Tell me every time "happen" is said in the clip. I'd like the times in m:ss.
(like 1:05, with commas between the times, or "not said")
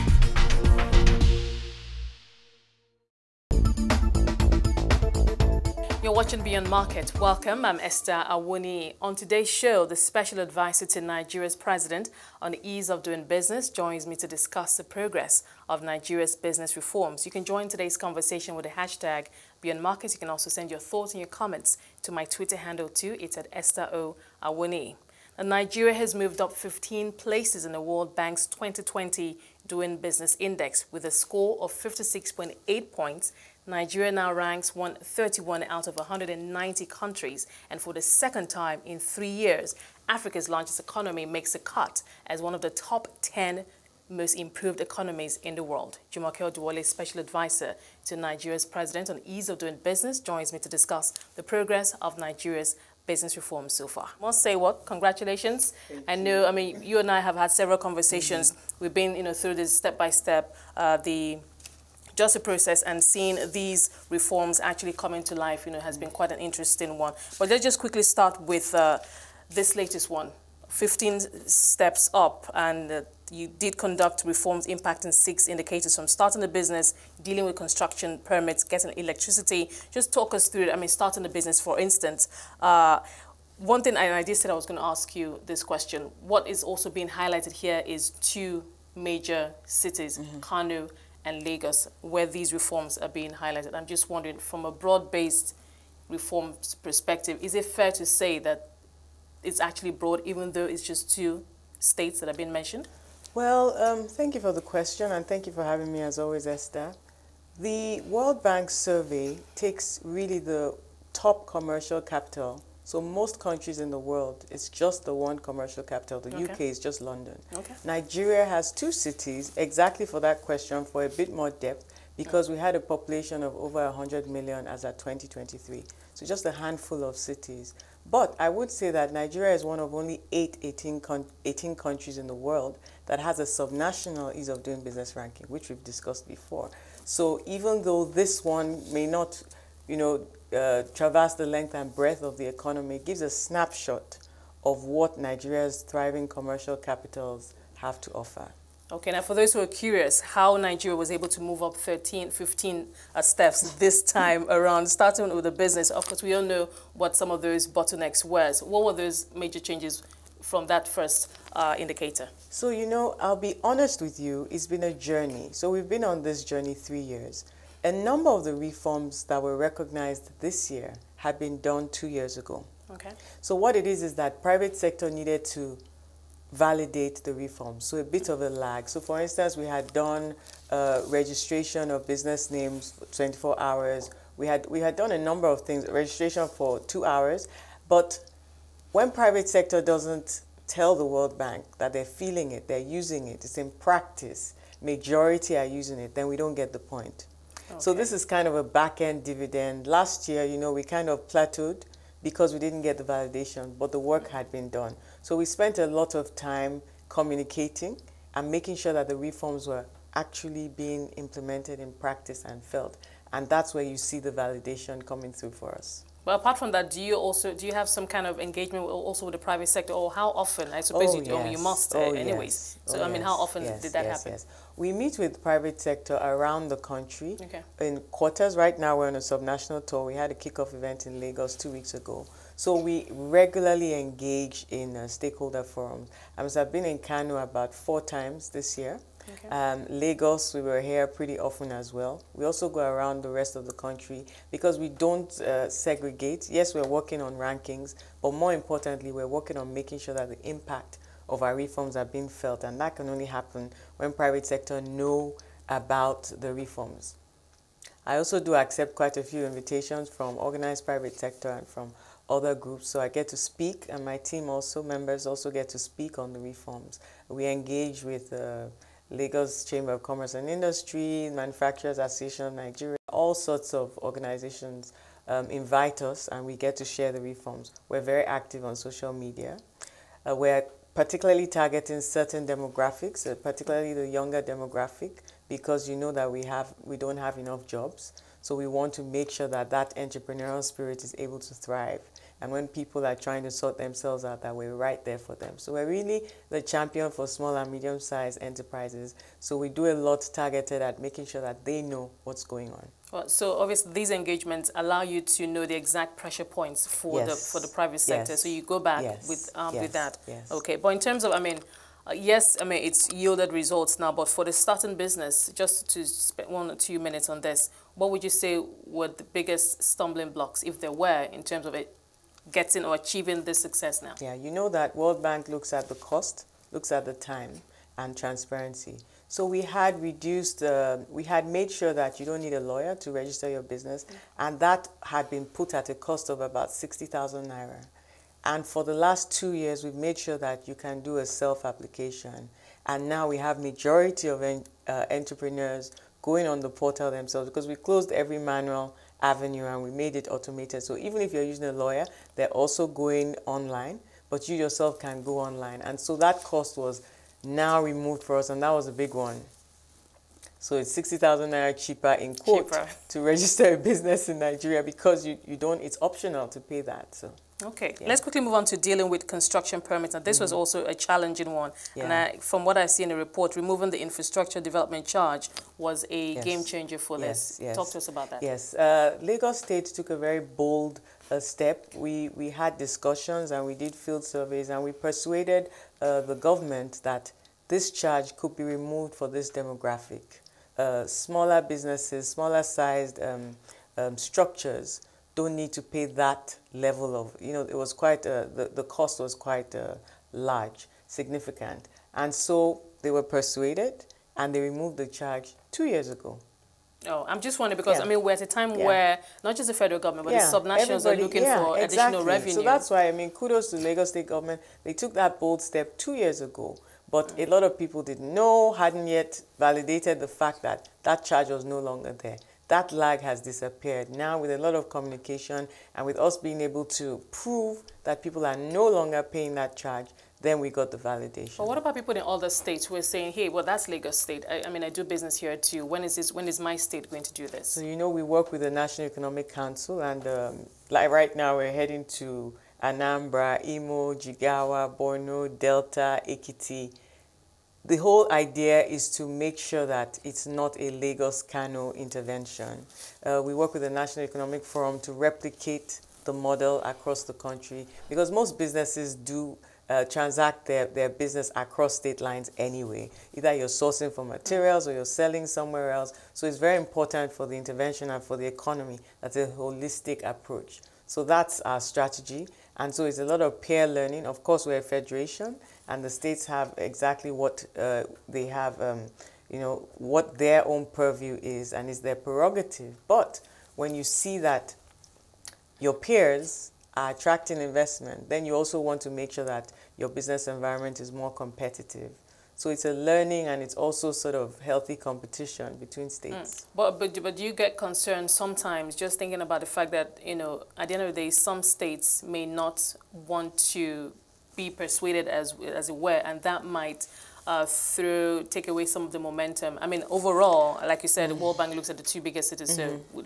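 3:44, 4:13.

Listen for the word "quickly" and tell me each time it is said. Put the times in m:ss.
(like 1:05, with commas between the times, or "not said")
1:07, 6:08.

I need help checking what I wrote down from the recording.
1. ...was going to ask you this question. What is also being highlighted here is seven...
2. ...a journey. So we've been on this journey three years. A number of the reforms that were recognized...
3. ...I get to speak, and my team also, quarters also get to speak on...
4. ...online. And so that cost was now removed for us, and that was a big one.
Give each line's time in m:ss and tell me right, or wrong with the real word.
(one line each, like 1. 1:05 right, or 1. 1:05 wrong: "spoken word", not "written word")
1. 1:24 wrong: "two", not "seven"
2. 2:44 right
3. 4:22 wrong: "members", not "quarters"
4. 5:55 right.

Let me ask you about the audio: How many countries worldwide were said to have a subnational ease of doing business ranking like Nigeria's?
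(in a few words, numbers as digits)
18.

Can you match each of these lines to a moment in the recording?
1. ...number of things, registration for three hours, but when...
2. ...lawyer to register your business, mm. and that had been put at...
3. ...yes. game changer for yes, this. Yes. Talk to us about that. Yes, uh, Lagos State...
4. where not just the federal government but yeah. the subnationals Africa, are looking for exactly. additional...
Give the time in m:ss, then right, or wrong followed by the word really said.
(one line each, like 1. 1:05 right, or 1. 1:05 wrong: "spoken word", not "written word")
1. 3:05 wrong: "two", not "three"
2. 5:32 right
3. 6:16 right
4. 6:48 wrong: "Everybody", not "Africa".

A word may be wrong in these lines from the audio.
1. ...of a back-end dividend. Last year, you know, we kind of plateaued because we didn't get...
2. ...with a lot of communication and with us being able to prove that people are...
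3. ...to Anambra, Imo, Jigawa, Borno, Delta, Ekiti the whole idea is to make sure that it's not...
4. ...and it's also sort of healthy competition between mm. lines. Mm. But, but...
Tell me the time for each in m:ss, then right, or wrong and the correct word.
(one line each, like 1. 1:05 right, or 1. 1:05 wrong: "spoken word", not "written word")
1. 3:18 right
2. 7:04 right
3. 7:22 right
4. 8:13 wrong: "states", not "lines".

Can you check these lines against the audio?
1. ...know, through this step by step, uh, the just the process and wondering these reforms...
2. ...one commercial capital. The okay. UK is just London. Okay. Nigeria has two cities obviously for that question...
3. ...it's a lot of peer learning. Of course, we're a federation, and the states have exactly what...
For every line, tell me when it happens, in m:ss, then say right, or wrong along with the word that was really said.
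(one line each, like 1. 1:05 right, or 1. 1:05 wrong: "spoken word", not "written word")
1. 0:59 wrong: "seeing", not "wondering"
2. 1:55 wrong: "exactly", not "obviously"
3. 7:53 right.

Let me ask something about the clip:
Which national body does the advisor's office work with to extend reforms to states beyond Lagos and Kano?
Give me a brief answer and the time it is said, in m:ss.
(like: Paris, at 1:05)
National Economic Council, at 7:18.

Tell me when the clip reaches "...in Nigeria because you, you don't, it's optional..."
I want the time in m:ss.
6:04.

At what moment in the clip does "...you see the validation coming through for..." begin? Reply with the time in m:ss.
3:33.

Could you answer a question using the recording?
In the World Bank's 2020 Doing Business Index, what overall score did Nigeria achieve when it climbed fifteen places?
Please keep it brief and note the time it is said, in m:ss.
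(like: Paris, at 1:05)
56.8 points, at 0:31.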